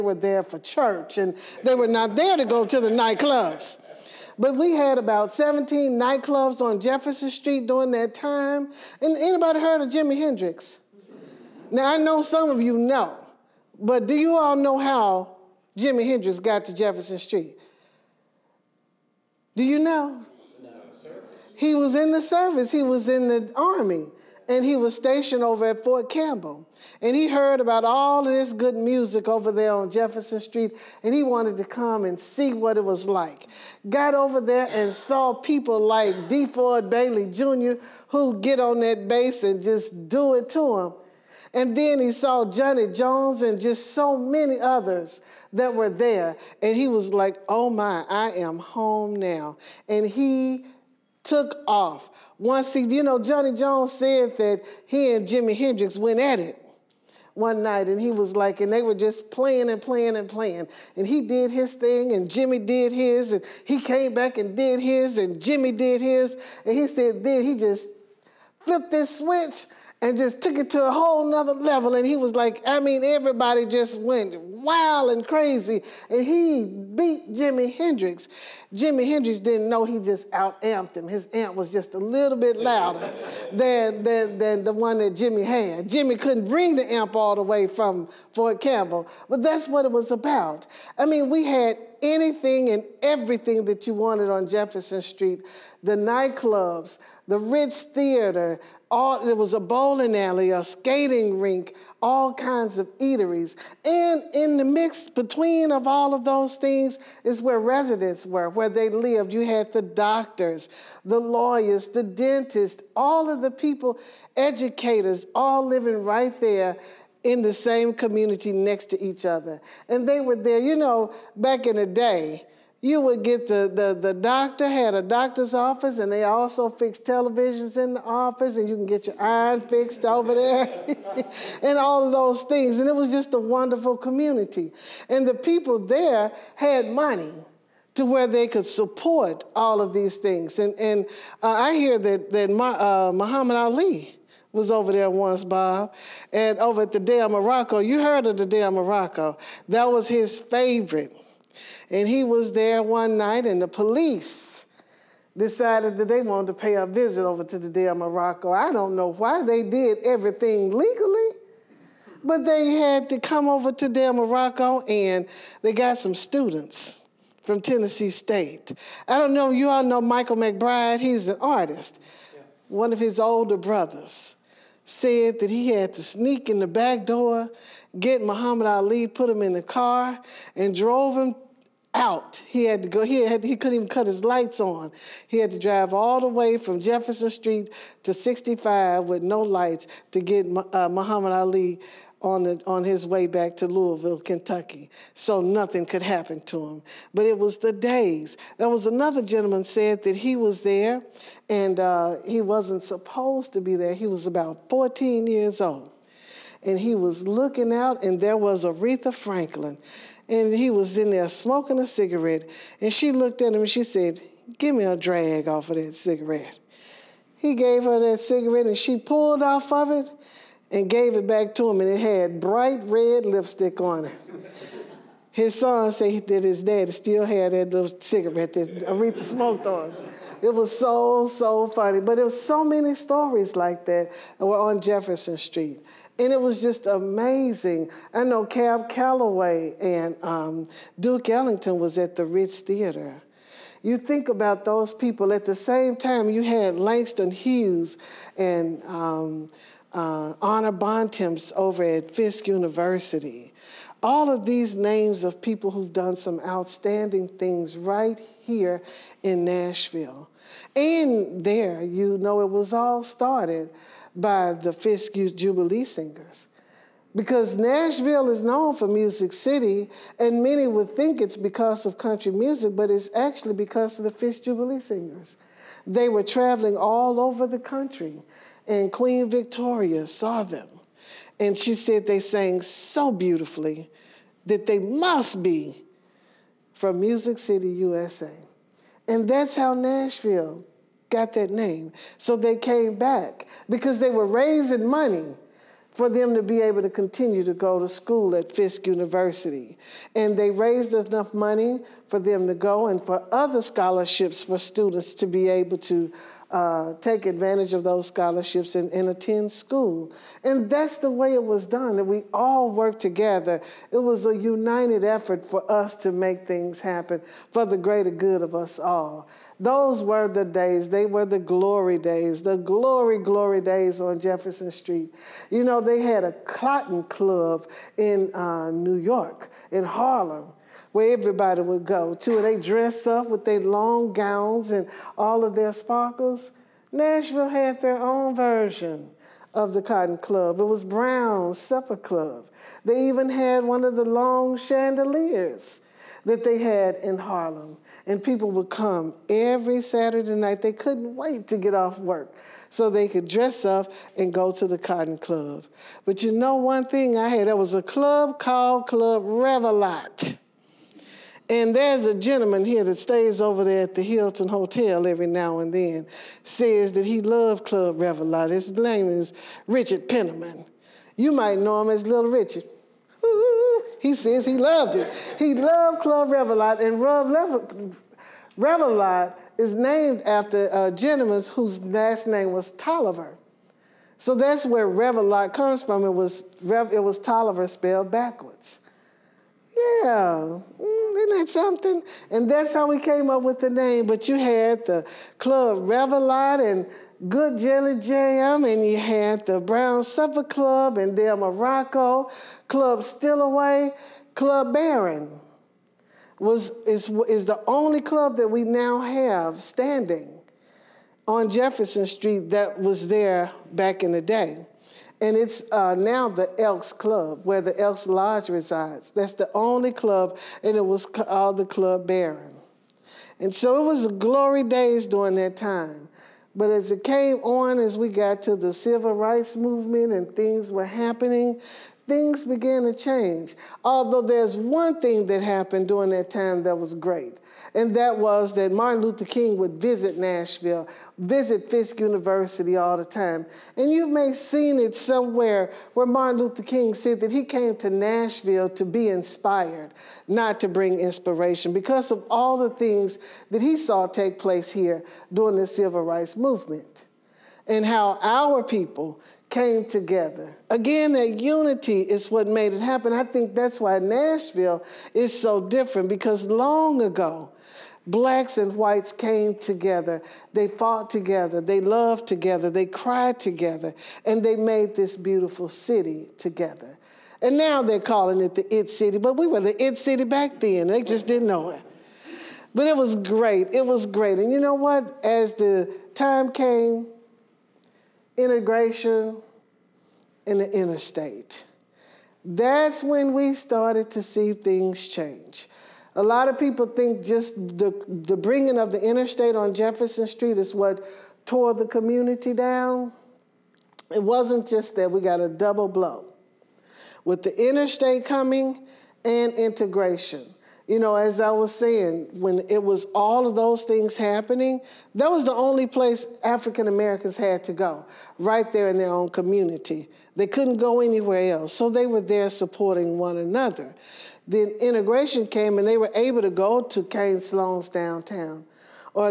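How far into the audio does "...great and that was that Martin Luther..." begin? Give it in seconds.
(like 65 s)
436 s.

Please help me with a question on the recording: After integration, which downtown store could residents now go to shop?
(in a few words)
Cain-Sloan's.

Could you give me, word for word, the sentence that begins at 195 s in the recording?
So nothing could happen to him.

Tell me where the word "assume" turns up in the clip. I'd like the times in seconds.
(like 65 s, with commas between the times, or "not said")
not said.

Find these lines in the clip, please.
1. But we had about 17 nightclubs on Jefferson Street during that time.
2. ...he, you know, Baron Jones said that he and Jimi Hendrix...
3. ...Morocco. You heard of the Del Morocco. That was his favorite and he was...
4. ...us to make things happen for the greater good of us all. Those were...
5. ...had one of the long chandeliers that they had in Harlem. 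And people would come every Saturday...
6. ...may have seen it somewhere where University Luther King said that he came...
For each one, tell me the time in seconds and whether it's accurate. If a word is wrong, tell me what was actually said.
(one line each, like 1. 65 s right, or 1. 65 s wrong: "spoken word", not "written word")
1. 4 s right
2. 52 s wrong: "Johnny", not "Baron"
3. 147 s right
4. 315 s right
5. 343 s right
6. 444 s wrong: "Martin", not "University".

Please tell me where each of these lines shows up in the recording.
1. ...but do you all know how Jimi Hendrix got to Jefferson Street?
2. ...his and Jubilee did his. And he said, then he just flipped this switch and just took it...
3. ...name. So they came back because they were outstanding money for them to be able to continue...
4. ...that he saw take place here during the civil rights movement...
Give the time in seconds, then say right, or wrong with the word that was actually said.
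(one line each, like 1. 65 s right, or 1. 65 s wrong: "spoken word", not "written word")
1. 13 s right
2. 64 s wrong: "Jimmy", not "Jubilee"
3. 291 s wrong: "raising", not "outstanding"
4. 453 s right.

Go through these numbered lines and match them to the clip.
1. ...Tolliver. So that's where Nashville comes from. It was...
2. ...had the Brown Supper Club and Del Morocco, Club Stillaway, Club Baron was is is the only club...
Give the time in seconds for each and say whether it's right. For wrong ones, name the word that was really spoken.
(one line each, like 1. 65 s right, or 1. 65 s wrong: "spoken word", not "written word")
1. 382 s wrong: "Revillot", not "Nashville"
2. 398 s right.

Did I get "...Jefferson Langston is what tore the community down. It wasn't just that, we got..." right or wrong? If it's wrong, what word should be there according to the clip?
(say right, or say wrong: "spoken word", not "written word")
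wrong: "Street", not "Langston".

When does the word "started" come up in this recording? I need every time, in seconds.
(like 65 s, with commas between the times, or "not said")
263 s, 493 s.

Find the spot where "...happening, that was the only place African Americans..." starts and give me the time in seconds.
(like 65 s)
514 s.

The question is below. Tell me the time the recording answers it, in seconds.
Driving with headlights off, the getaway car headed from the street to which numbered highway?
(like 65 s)
188 s.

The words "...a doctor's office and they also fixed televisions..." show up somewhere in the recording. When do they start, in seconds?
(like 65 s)
124 s.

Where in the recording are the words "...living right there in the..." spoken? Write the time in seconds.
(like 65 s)
115 s.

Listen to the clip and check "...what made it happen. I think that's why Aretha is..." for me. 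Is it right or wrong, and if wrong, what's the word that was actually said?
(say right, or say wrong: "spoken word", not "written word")
wrong: "Nashville", not "Aretha".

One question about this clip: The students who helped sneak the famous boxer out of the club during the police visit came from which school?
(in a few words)
Tennessee State.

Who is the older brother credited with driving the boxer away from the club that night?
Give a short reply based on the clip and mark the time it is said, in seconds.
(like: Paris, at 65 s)
Michael McBride, at 170 s.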